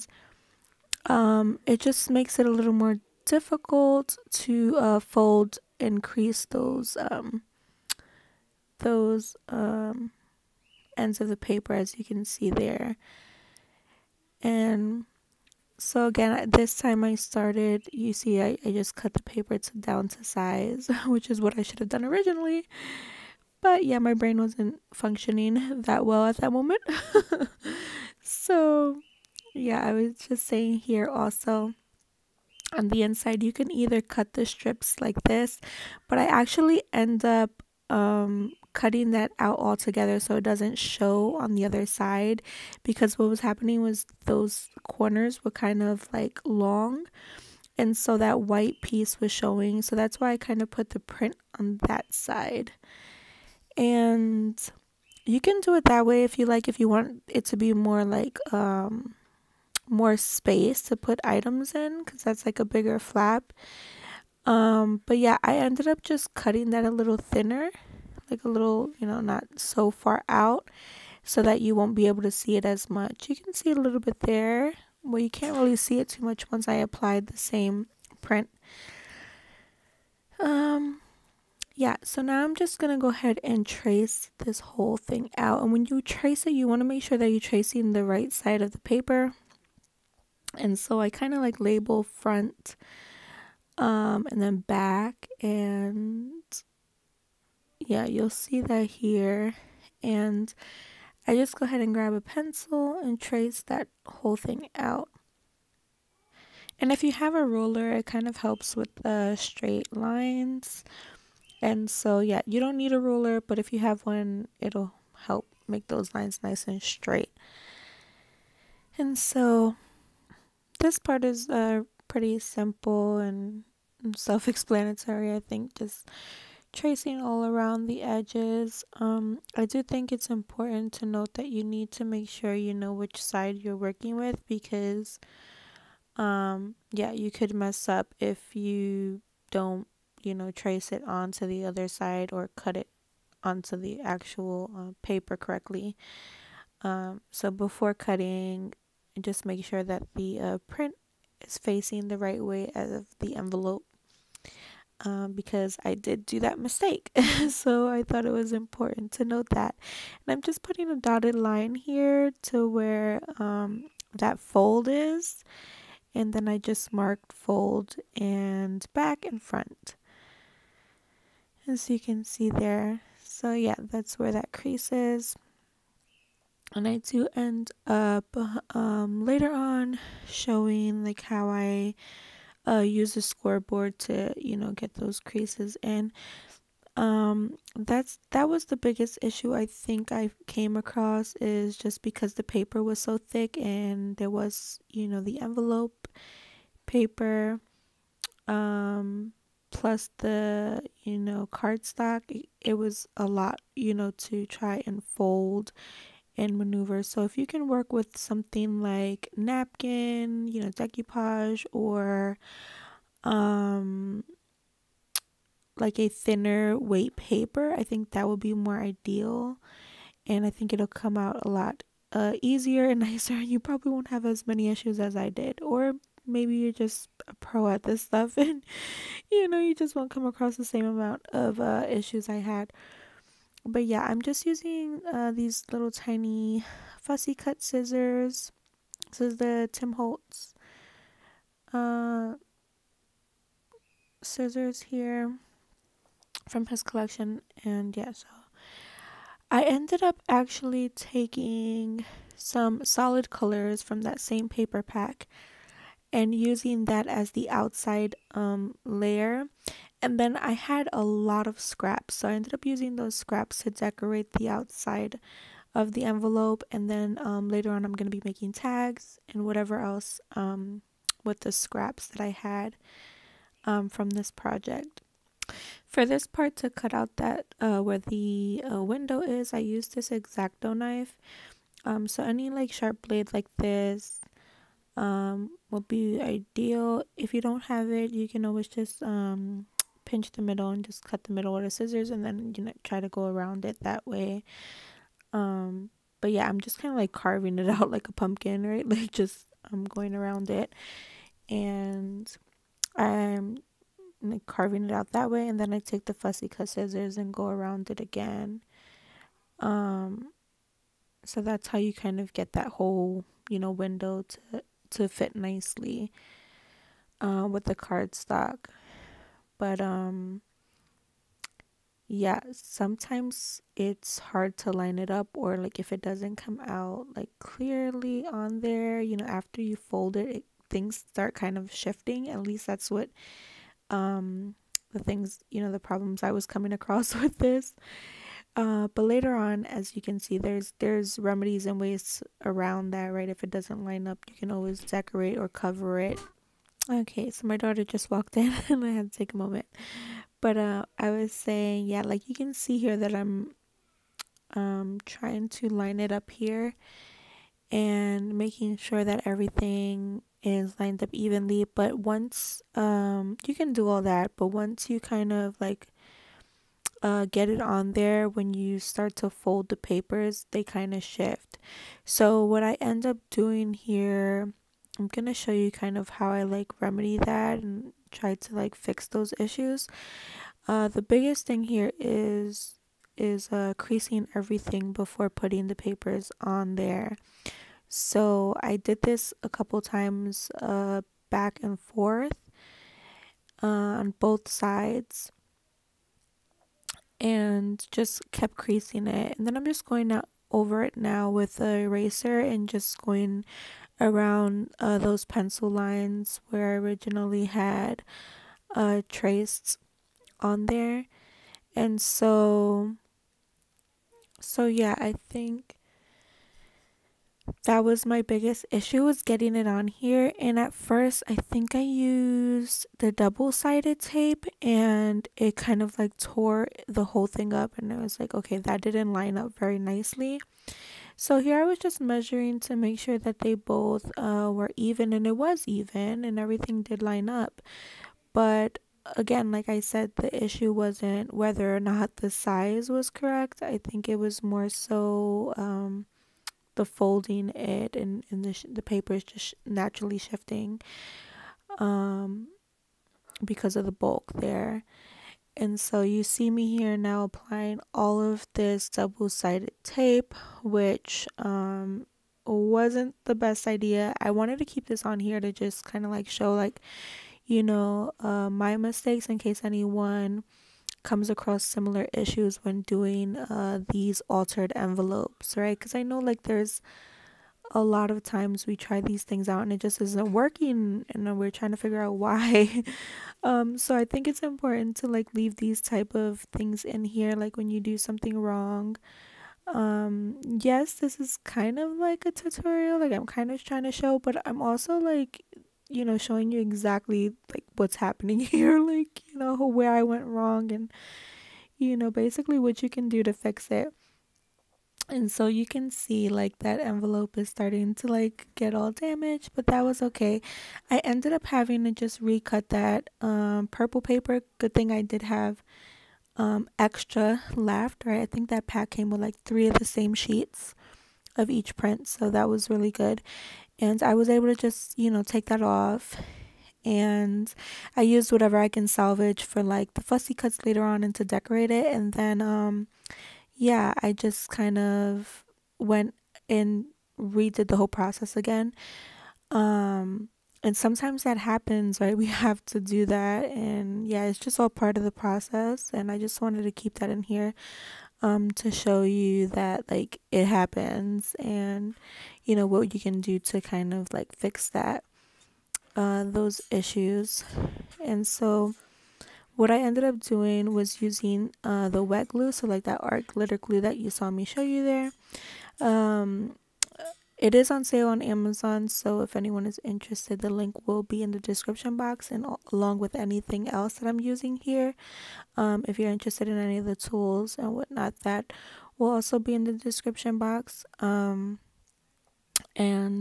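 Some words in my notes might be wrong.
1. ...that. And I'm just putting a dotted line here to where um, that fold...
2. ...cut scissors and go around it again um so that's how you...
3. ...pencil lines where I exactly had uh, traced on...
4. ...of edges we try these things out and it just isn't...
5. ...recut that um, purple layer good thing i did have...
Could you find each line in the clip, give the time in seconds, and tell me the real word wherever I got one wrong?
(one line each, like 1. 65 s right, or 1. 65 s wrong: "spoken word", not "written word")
1. 159 s right
2. 306 s right
3. 405 s wrong: "originally", not "exactly"
4. 478 s wrong: "times", not "edges"
5. 512 s wrong: "paper", not "layer".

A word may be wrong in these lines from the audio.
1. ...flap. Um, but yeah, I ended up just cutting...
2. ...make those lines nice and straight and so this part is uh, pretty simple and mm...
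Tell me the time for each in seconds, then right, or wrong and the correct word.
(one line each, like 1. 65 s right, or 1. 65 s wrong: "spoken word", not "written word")
1. 62 s right
2. 115 s right.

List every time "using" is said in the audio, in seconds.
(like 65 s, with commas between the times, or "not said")
234 s, 256 s, 262 s, 561 s, 574 s.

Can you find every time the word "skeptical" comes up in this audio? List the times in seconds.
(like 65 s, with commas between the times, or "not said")
not said.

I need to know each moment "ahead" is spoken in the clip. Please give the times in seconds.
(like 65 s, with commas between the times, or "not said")
83 s, 101 s.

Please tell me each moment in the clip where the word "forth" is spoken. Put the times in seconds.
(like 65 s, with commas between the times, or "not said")
391 s.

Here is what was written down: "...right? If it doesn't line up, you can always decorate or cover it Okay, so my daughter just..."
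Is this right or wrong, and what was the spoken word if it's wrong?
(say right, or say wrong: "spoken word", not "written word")
right.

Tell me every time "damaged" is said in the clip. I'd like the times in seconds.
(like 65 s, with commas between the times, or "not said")
508 s.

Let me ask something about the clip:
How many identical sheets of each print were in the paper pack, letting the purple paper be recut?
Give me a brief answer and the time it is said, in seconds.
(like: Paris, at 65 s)
3, at 519 s.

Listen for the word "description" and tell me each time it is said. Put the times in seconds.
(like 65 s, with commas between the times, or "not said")
571 s, 579 s.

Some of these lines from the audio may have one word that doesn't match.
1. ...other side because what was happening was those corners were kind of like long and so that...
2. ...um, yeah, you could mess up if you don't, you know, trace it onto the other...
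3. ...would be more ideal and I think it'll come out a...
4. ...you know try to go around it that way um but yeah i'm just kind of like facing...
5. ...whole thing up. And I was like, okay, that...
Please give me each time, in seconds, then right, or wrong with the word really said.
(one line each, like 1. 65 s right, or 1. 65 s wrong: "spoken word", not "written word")
1. 41 s right
2. 136 s right
3. 218 s right
4. 292 s wrong: "carving", not "facing"
5. 427 s right.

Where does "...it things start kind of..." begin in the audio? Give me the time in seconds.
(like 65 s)
330 s.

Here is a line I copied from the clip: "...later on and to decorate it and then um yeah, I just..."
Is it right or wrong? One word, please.
right.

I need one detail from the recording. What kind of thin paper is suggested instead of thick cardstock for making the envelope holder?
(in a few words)
napkin.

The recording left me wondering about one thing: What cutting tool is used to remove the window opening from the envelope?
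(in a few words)
Exacto knife.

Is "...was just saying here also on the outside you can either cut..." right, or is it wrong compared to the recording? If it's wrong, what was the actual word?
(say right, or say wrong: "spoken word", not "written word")
wrong: "inside", not "outside".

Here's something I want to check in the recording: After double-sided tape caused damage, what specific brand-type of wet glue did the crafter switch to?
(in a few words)
art glitter glue.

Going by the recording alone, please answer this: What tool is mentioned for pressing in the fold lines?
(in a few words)
scoreboard.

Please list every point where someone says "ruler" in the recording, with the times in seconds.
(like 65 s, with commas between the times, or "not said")
107 s, 113 s.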